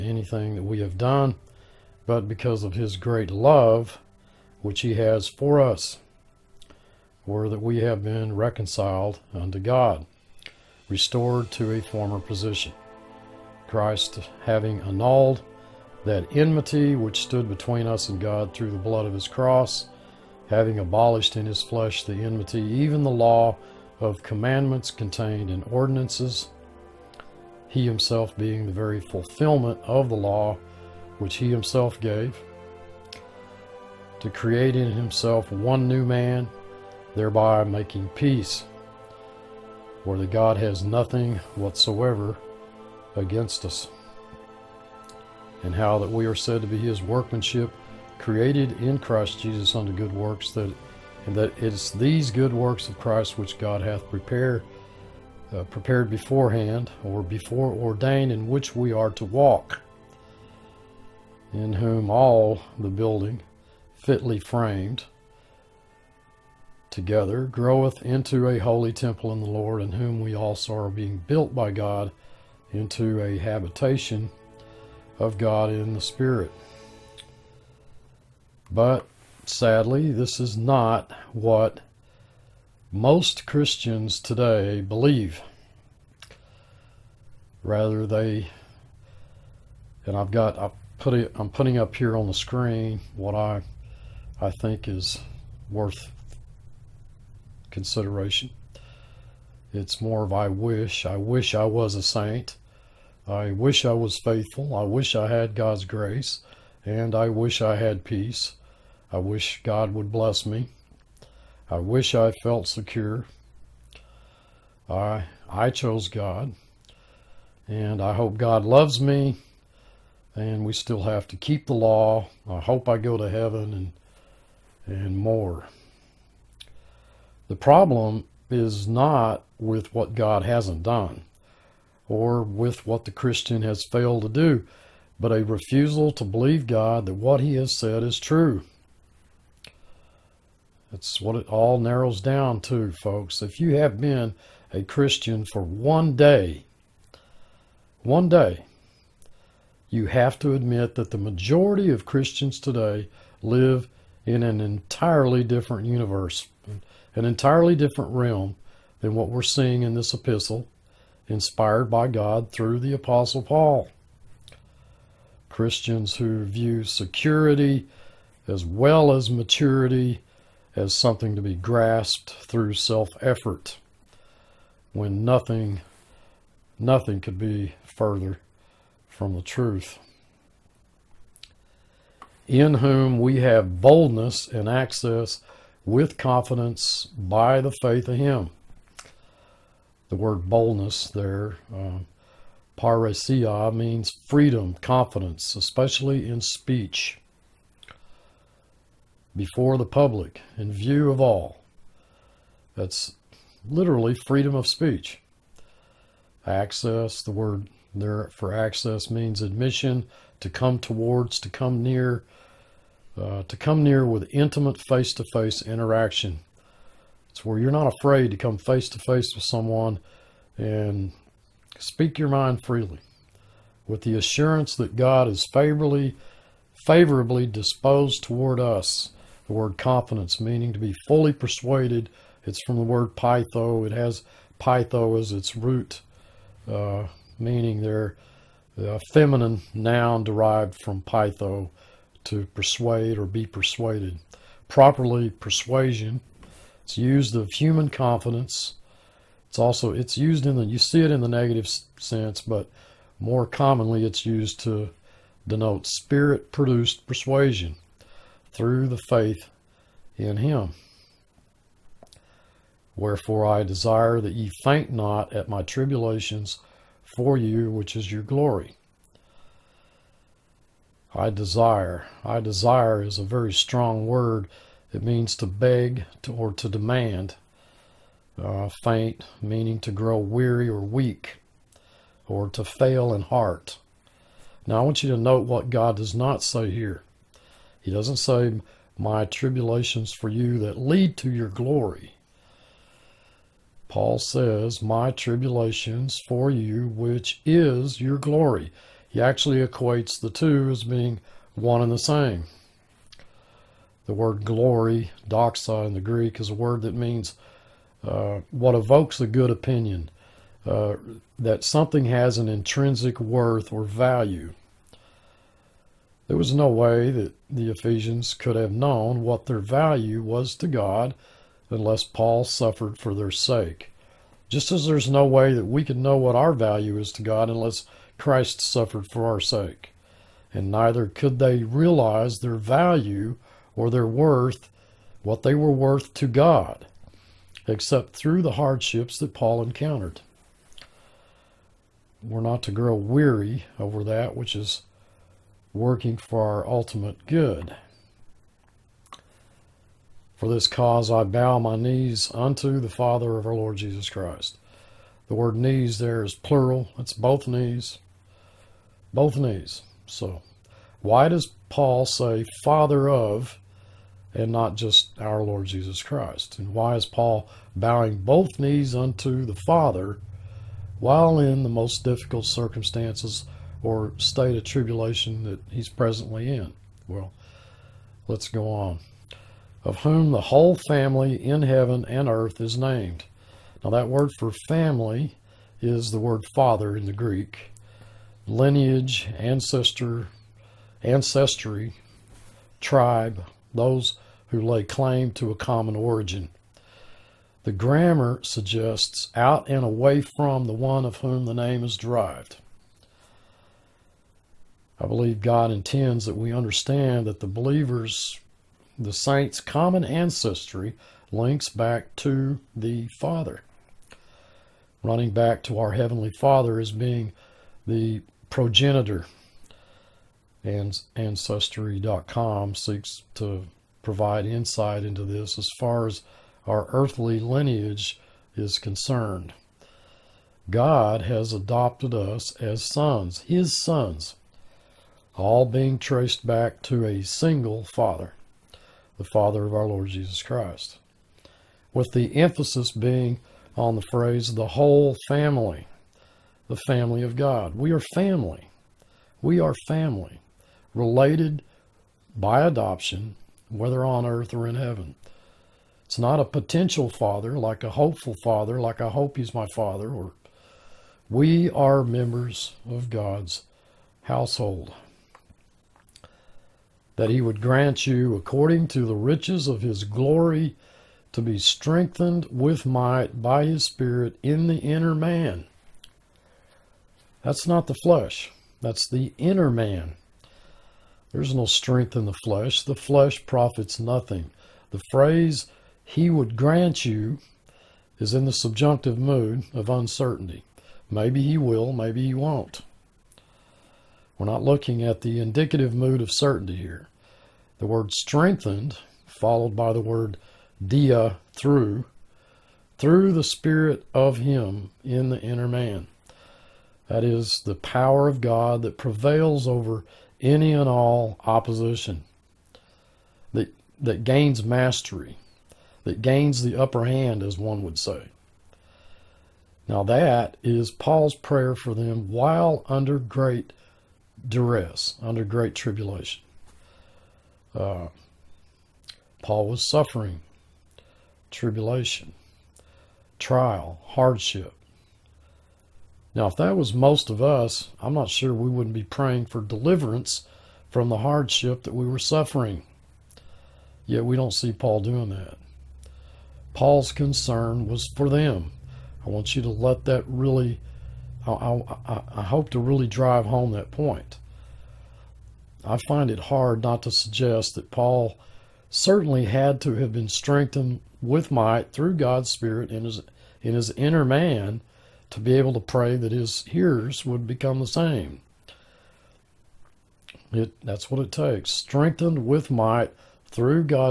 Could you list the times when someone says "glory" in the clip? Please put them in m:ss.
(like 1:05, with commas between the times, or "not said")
4:28, 4:51, 4:58, 5:04, 7:50.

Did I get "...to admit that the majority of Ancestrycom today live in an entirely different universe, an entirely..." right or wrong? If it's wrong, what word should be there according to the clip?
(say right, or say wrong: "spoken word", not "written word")
wrong: "Christians", not "Ancestrycom".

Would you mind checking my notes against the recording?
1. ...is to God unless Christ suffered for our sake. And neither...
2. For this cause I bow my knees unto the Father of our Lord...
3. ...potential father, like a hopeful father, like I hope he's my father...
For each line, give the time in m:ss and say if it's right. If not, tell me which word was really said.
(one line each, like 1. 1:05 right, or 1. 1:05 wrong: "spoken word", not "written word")
1. 5:26 right
2. 5:50 right
3. 7:36 right.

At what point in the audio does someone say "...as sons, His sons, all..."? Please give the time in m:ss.
7:12.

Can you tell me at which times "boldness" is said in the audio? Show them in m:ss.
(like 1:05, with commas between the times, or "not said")
3:03, 3:10.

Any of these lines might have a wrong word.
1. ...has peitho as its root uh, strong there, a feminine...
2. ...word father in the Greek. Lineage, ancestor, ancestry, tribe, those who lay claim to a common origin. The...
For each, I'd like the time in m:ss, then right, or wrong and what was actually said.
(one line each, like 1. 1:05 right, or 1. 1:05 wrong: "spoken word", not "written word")
1. 3:53 wrong: "meaning", not "strong"
2. 6:26 right.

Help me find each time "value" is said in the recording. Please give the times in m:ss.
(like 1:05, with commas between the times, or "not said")
5:13, 5:19, 5:26, 5:32.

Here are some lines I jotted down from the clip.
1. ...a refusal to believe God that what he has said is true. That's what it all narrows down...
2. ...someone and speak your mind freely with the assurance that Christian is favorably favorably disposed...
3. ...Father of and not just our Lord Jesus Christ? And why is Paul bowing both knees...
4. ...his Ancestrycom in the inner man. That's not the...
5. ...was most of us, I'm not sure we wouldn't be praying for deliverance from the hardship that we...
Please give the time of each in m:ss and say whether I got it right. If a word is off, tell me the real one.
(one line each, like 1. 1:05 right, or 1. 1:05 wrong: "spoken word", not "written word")
1. 2:15 right
2. 3:39 wrong: "God", not "Christian"
3. 6:02 right
4. 7:53 wrong: "Spirit", not "Ancestrycom"
5. 8:56 right.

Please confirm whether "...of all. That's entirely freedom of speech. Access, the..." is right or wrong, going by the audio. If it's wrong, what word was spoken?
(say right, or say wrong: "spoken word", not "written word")
wrong: "literally", not "entirely".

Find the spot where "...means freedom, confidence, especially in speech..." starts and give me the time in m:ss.
3:13.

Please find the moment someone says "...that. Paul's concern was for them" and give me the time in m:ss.
9:05.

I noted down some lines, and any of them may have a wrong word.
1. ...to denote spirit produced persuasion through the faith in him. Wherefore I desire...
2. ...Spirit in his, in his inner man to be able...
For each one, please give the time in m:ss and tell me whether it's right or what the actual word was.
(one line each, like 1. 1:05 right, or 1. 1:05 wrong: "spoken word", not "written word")
1. 4:14 right
2. 9:22 right.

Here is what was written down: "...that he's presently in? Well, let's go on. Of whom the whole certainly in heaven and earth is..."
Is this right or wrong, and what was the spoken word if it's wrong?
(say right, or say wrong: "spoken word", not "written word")
wrong: "family", not "certainly".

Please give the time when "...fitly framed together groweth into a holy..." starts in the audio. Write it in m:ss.
1:03.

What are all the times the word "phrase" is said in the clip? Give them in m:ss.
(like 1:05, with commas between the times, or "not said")
7:24, 8:05.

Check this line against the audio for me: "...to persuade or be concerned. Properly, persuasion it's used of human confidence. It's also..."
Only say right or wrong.
wrong.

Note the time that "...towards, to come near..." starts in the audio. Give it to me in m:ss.
3:30.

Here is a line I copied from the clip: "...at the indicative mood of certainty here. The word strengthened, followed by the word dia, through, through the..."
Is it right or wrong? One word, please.
right.